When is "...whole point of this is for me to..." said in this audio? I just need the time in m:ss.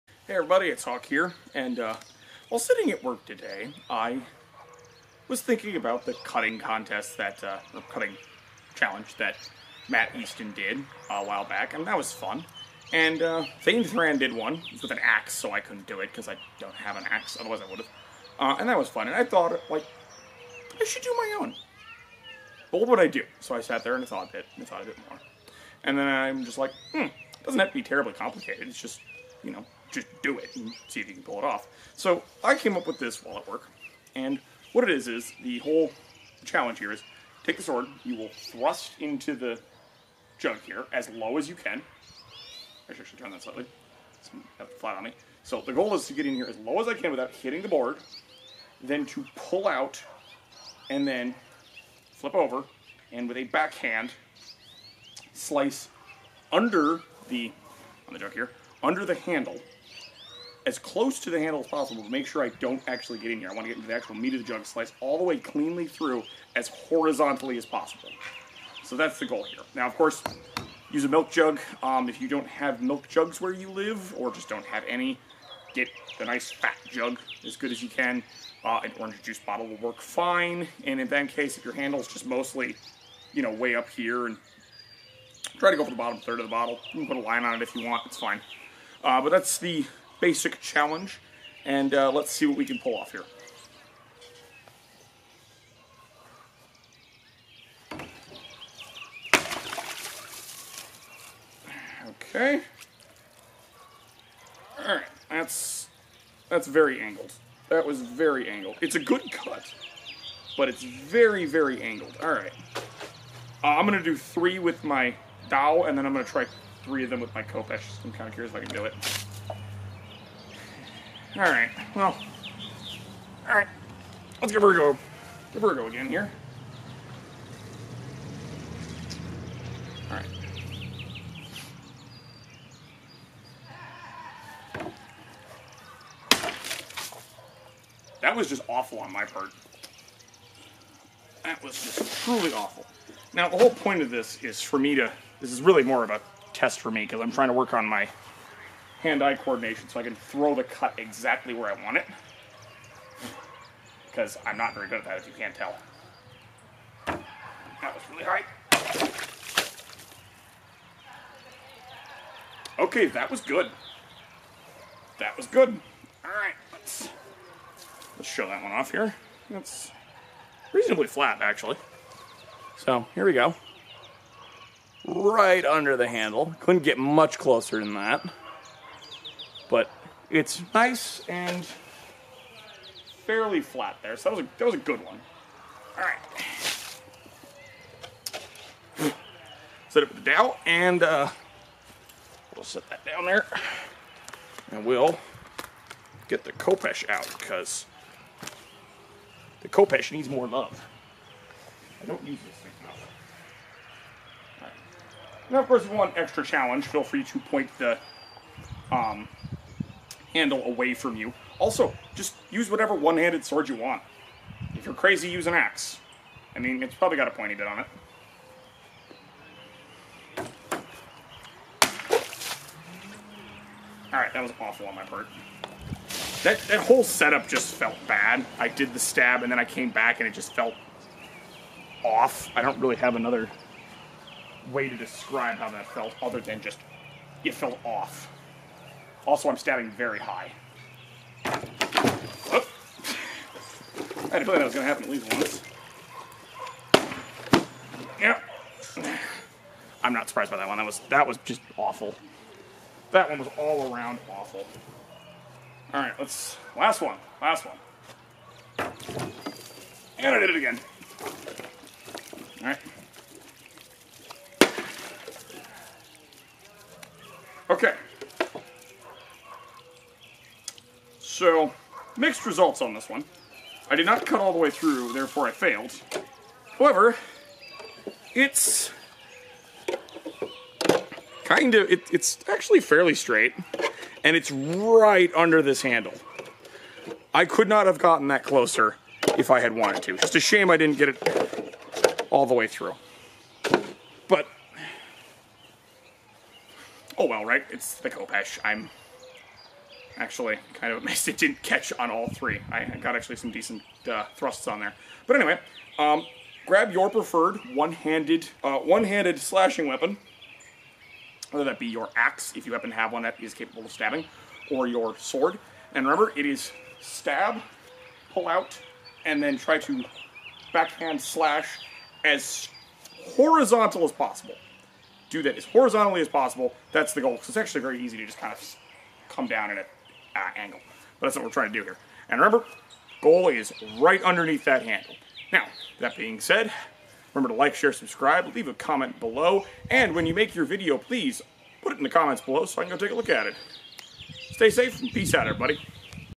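2:23.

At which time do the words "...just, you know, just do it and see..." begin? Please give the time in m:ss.
0:28.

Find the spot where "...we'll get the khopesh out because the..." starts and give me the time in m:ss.
3:14.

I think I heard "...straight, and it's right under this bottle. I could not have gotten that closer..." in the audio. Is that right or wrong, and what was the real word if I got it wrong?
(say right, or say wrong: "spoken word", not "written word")
wrong: "handle", not "bottle".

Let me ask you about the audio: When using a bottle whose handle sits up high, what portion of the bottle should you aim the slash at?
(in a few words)
Bottom third.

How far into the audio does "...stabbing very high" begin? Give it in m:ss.
3:59.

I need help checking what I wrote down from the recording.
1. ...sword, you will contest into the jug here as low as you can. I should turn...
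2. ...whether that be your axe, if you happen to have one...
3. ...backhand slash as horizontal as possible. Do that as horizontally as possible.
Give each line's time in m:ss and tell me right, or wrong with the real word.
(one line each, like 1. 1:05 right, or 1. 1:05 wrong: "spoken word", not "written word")
1. 0:37 wrong: "thrust", not "contest"
2. 5:11 right
3. 5:20 right.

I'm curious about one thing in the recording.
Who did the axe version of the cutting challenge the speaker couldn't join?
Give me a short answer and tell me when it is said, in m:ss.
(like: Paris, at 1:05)
Thegn Thrand, at 0:13.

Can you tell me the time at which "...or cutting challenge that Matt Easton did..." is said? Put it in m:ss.
0:07.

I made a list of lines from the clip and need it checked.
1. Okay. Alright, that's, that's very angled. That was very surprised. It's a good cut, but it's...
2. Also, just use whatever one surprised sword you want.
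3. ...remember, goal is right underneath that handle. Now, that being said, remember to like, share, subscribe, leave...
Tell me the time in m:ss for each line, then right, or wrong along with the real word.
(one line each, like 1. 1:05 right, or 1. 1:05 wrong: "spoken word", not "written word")
1. 1:42 wrong: "angled", not "surprised"
2. 3:31 wrong: "handed", not "surprised"
3. 5:32 right.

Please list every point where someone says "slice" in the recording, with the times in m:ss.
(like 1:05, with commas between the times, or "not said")
0:55, 1:04.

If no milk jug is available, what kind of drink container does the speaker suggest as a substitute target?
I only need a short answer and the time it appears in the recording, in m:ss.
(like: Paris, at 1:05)
An orange juice bottle, at 1:18.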